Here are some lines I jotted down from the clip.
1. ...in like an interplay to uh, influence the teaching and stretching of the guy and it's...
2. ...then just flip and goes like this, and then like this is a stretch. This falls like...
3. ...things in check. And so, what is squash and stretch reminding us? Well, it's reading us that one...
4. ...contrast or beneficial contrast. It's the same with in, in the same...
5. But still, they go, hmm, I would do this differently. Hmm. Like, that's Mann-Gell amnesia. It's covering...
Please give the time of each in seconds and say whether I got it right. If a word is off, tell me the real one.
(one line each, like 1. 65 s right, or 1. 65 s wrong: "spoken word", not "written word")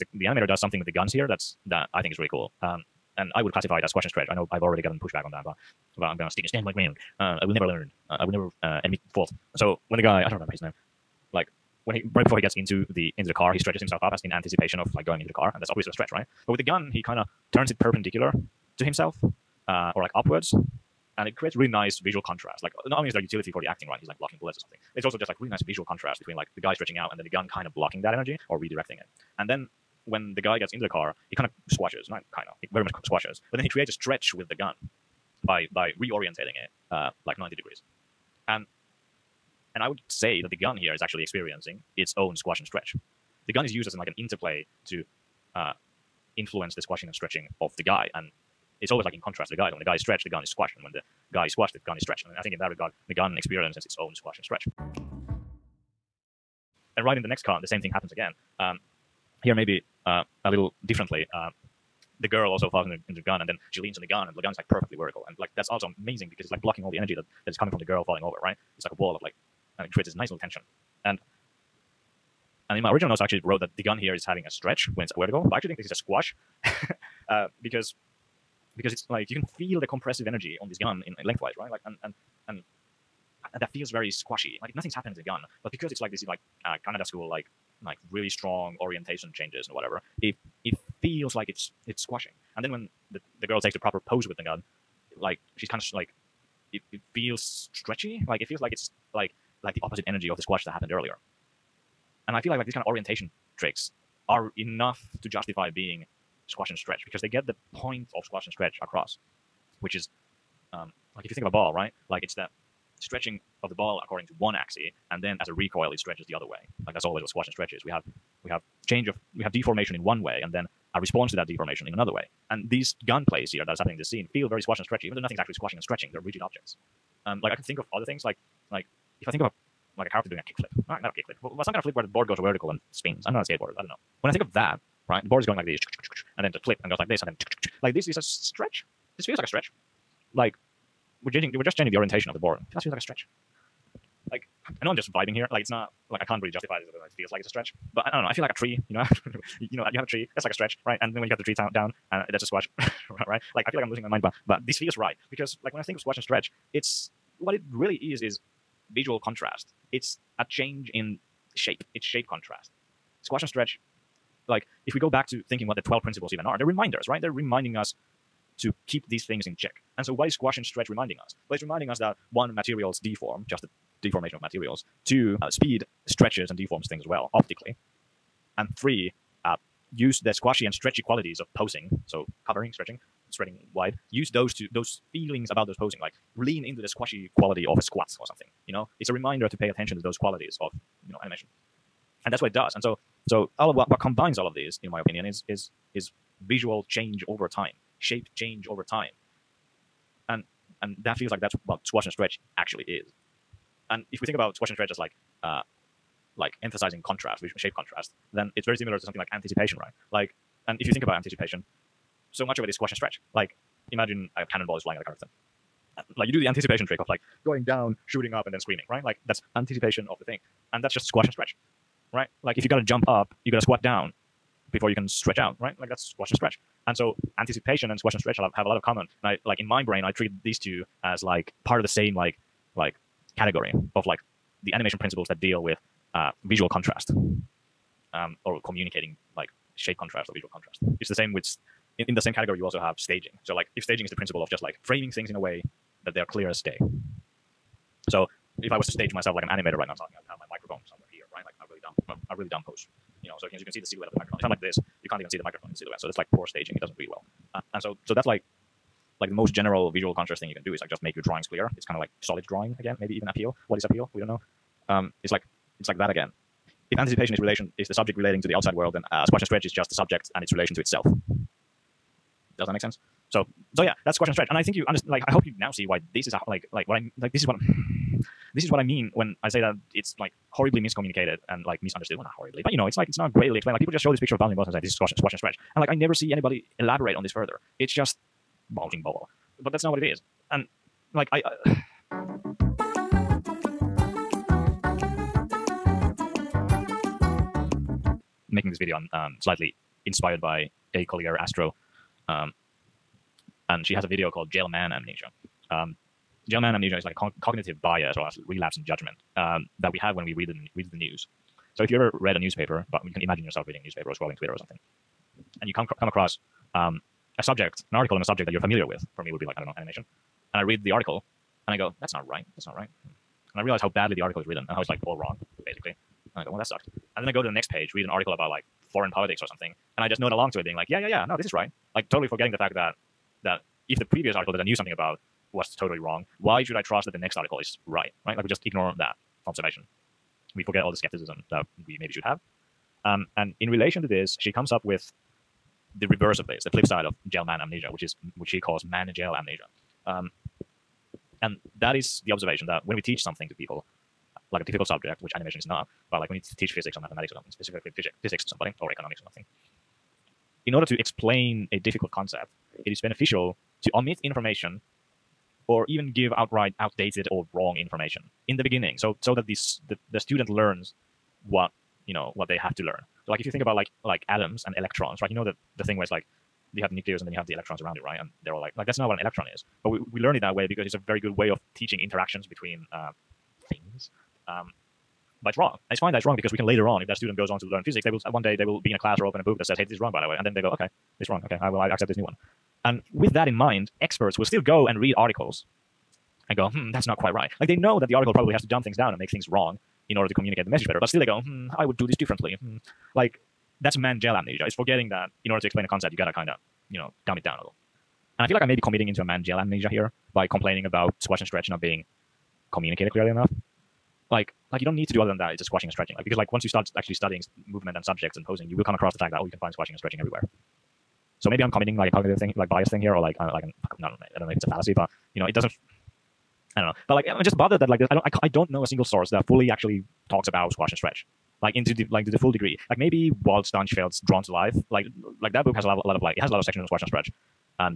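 1. 43 s wrong: "squashing", not "teaching"
2. 136 s wrong: "feels", not "falls"
3. 169 s wrong: "reminding", not "reading"
4. 239 s wrong: "visual", not "beneficial"
5. 400 s wrong: "forgetting", not "covering".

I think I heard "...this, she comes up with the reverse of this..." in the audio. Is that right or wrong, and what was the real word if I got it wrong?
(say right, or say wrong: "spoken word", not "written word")
right.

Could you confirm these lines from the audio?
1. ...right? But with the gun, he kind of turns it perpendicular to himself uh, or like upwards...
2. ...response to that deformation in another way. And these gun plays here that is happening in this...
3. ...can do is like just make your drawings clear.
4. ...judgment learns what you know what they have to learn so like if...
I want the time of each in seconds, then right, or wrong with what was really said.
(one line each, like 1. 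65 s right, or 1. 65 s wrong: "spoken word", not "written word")
1. 16 s right
2. 120 s right
3. 260 s right
4. 370 s wrong: "student", not "judgment".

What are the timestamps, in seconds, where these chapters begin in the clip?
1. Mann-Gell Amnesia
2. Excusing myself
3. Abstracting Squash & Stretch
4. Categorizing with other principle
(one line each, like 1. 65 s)
1. 292 s
2. 272 s
3. 153 s
4. 204 s.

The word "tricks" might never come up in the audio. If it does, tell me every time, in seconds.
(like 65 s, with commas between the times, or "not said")
103 s, 216 s.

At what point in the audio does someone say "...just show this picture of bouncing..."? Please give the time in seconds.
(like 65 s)
283 s.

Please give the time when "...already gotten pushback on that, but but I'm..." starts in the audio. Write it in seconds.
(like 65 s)
4 s.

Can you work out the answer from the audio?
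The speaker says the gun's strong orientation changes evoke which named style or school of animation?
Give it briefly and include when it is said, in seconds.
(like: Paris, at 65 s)
Kanada school, at 86 s.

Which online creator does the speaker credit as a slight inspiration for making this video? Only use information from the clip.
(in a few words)
acollierastro.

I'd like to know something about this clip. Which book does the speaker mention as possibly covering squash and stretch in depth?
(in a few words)
Drawn to Life.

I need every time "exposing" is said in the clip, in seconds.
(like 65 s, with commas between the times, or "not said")
not said.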